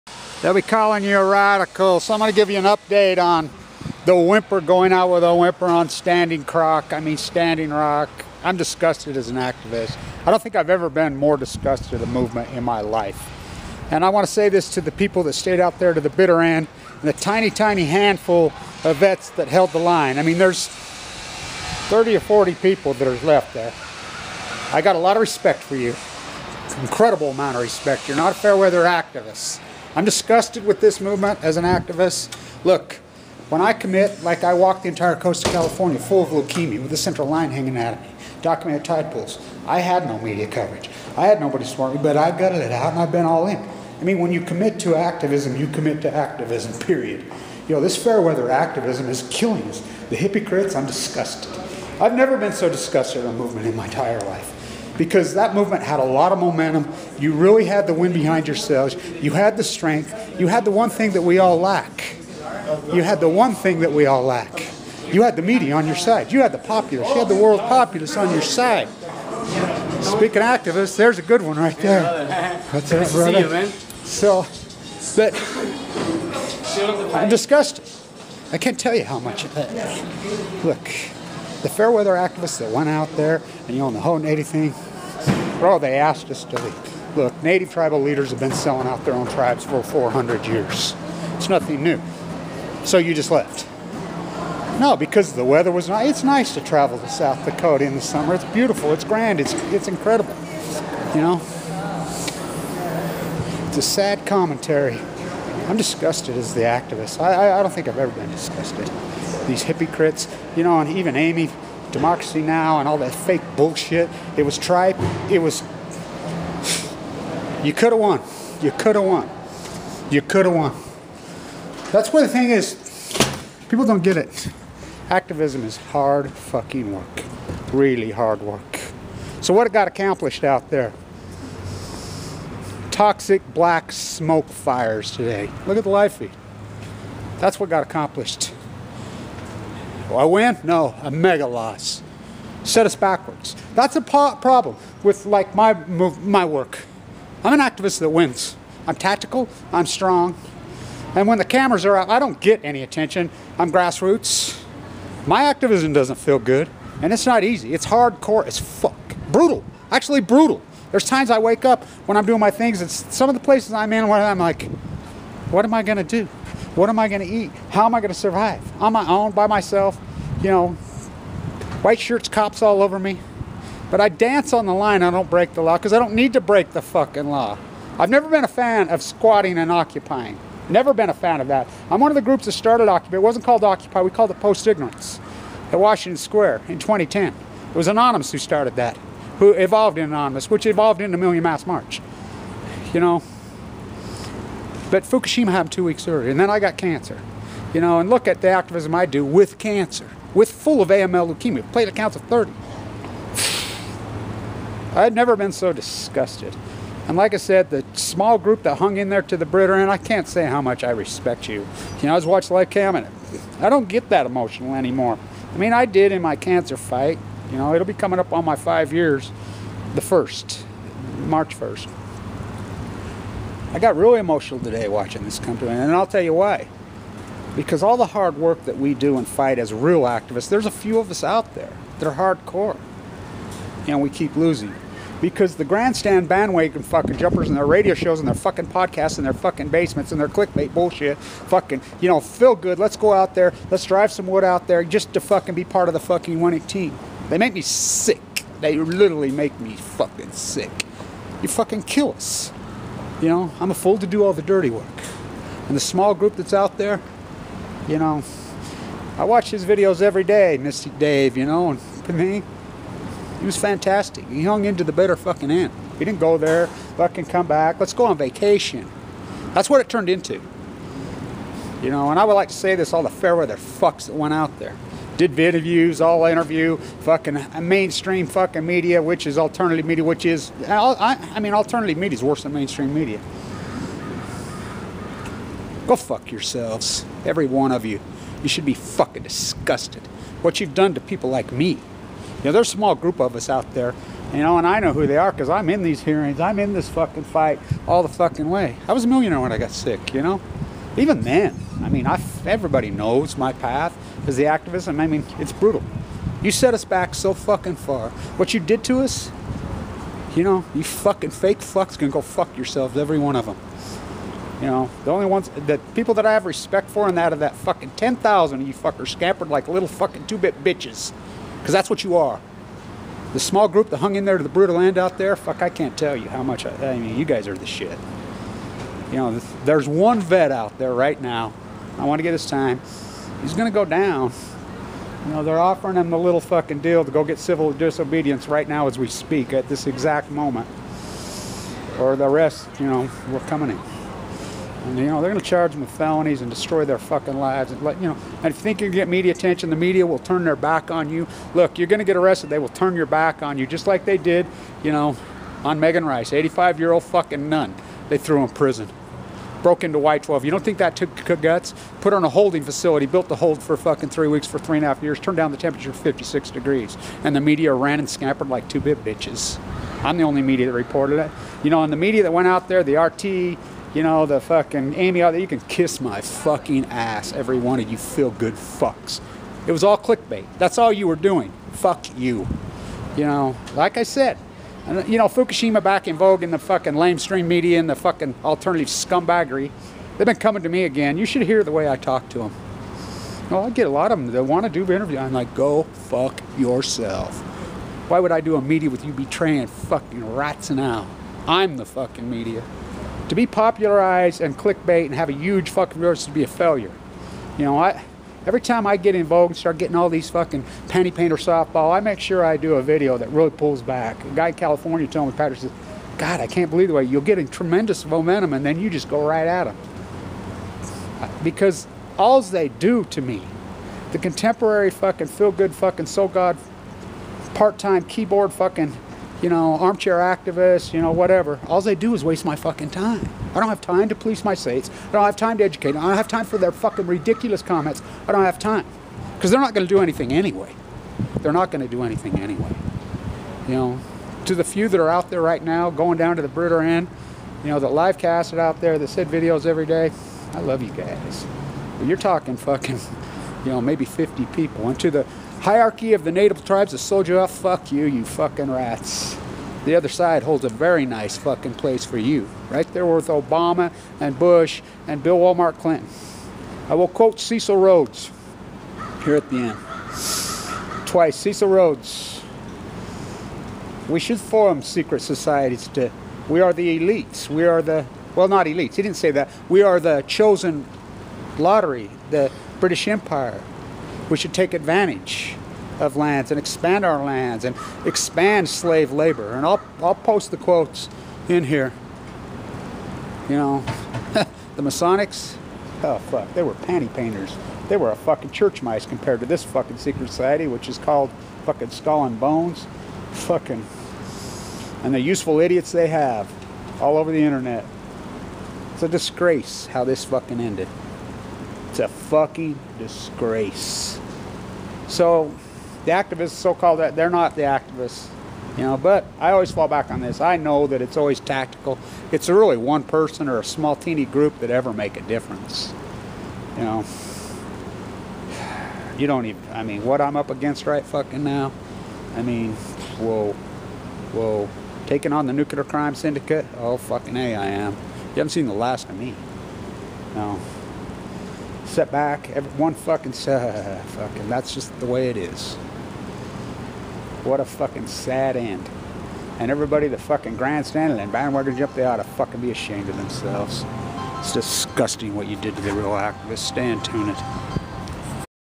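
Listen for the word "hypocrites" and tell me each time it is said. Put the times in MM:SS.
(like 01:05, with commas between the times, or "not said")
00:50, 01:49.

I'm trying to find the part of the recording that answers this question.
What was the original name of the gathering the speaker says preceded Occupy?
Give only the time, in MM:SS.
03:04.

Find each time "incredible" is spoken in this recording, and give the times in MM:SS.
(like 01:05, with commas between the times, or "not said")
00:26, 01:39.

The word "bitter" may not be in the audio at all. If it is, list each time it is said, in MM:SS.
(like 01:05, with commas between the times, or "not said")
00:16, 03:29, 04:24.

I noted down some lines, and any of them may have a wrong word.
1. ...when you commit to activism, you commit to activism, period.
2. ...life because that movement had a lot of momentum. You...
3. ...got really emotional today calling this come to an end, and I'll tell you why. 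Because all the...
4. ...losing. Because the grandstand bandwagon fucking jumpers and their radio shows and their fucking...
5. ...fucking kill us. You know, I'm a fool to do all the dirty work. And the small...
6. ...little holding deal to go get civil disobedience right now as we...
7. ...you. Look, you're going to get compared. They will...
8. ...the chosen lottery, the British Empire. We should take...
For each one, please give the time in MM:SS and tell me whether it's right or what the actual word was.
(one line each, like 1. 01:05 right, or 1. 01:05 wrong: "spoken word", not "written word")
1. 00:44 right
2. 00:54 right
3. 03:43 wrong: "watching", not "calling"
4. 03:54 right
5. 04:11 right
6. 05:36 wrong: "fucking", not "holding"
7. 05:51 wrong: "arrested", not "compared"
8. 07:59 right.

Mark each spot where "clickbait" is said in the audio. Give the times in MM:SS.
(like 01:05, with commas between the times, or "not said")
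04:00, 06:19, 06:44.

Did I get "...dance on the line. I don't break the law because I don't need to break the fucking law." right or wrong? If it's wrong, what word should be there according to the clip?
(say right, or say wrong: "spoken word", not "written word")
right.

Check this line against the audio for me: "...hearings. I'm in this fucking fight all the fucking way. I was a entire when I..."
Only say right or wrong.
wrong.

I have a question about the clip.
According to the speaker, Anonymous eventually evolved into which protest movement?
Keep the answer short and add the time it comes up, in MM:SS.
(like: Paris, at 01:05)
Million Mask March, at 03:11.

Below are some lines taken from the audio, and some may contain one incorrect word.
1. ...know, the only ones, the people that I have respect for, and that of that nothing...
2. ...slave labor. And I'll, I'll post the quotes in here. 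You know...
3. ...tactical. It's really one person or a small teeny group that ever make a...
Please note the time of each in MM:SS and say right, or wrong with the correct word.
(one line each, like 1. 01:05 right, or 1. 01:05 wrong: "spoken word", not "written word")
1. 05:14 wrong: "fucking", not "nothing"
2. 08:08 right
3. 08:41 right.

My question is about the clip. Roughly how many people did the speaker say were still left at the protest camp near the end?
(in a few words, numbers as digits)
30 or 40.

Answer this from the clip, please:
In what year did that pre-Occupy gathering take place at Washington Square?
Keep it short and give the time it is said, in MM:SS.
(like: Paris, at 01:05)
2010, at 03:06.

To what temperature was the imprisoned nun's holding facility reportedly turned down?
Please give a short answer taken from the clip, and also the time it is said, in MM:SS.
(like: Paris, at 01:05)
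56 degrees, at 06:05.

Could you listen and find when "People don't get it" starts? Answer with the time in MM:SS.
02:03.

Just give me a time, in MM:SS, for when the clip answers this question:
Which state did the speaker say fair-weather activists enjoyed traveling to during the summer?
01:37.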